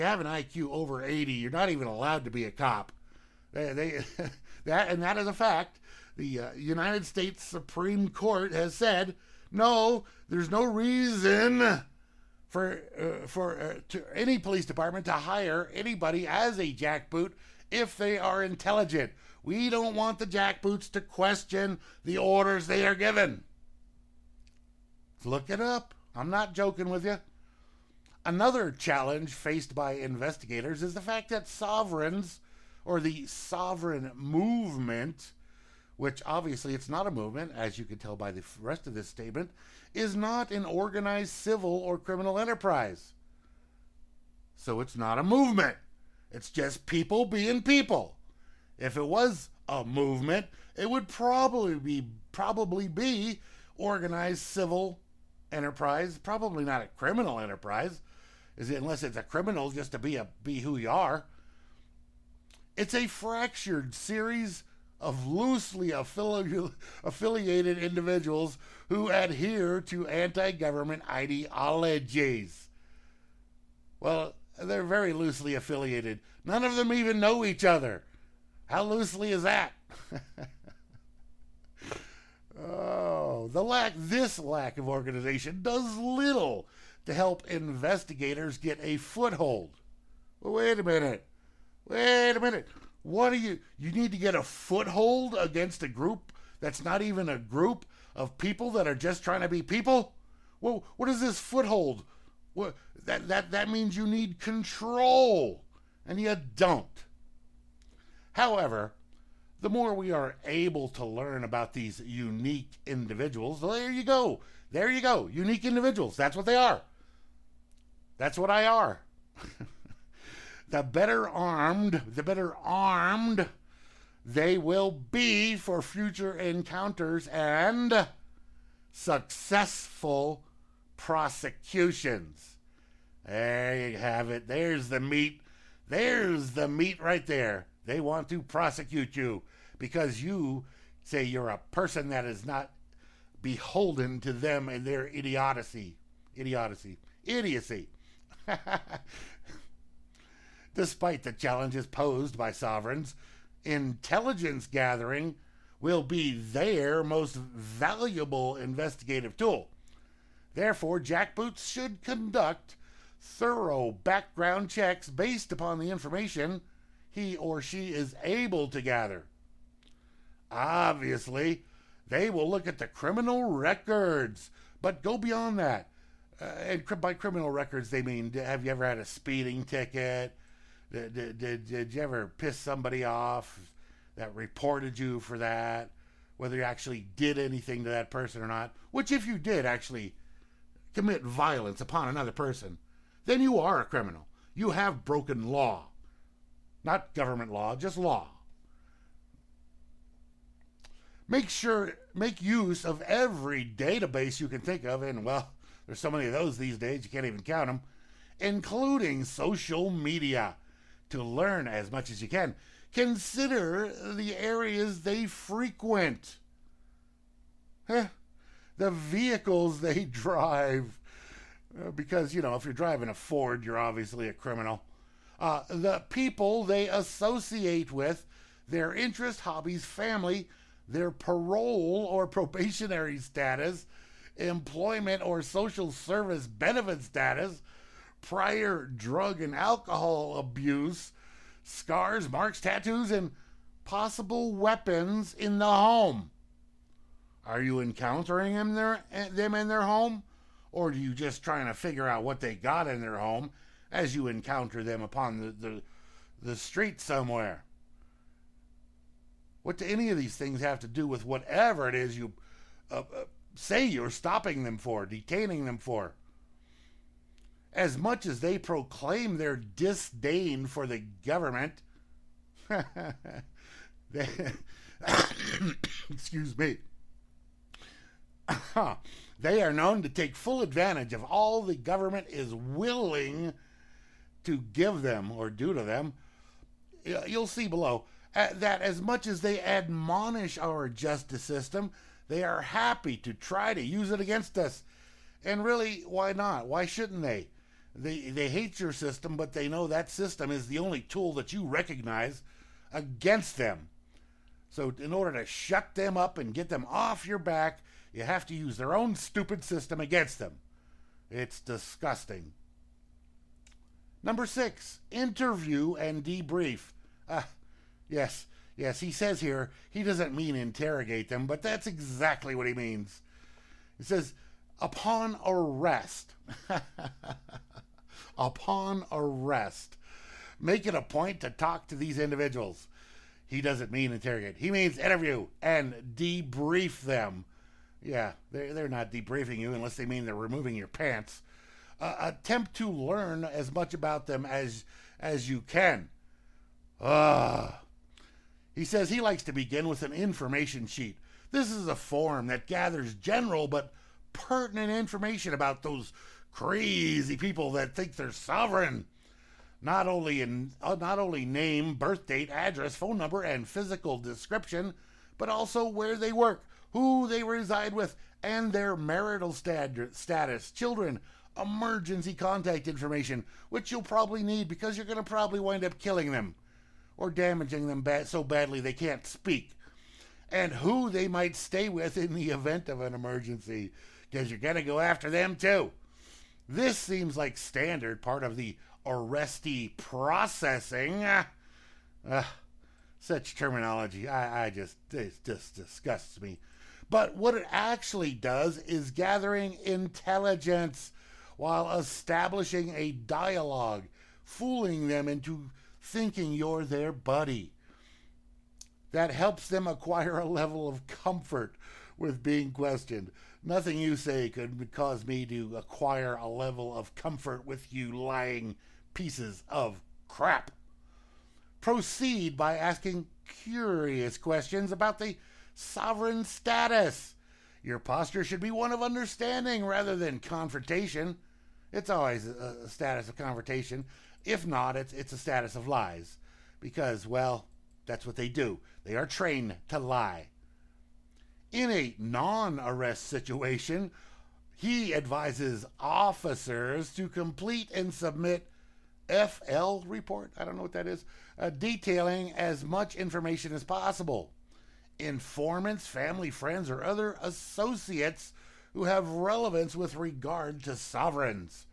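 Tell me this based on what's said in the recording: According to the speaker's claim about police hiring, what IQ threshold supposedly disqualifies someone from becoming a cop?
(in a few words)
80.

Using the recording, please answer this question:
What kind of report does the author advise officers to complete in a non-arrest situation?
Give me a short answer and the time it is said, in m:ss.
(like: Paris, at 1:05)
FL report, at 7:29.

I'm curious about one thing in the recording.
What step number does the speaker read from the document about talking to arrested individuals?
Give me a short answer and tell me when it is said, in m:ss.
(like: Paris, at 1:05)
6, at 5:14.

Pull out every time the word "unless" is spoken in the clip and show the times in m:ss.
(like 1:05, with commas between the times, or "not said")
0:58, 5:39.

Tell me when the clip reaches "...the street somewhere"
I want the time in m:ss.
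4:16.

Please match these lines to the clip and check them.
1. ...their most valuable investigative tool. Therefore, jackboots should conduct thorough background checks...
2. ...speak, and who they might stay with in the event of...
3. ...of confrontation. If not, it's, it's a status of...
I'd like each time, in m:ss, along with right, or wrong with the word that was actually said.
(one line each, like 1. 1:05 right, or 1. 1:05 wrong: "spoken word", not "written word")
1. 2:36 right
2. 6:19 right
3. 7:13 right.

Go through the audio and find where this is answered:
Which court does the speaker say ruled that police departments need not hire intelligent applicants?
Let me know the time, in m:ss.
0:06.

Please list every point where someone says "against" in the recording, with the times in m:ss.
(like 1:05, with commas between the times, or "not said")
1:35, 4:54, 5:02, 5:09.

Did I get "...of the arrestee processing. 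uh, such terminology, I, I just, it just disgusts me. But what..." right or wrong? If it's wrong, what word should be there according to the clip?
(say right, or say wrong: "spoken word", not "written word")
right.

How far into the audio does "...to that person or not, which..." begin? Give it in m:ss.
3:07.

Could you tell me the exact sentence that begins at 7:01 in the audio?
Proceed by asking curious questions about the sovereign status.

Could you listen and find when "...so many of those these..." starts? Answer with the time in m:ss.
3:25.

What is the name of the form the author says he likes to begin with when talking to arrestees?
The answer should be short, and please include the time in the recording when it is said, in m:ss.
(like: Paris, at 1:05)
information sheet, at 5:50.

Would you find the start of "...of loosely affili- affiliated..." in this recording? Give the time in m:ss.
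1:04.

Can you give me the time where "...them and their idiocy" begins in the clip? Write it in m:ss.
2:24.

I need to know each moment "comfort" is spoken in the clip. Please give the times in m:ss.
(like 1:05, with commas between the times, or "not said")
6:51, 6:57.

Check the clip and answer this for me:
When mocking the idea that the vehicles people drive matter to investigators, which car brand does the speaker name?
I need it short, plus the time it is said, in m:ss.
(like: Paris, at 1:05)
Ford, at 3:43.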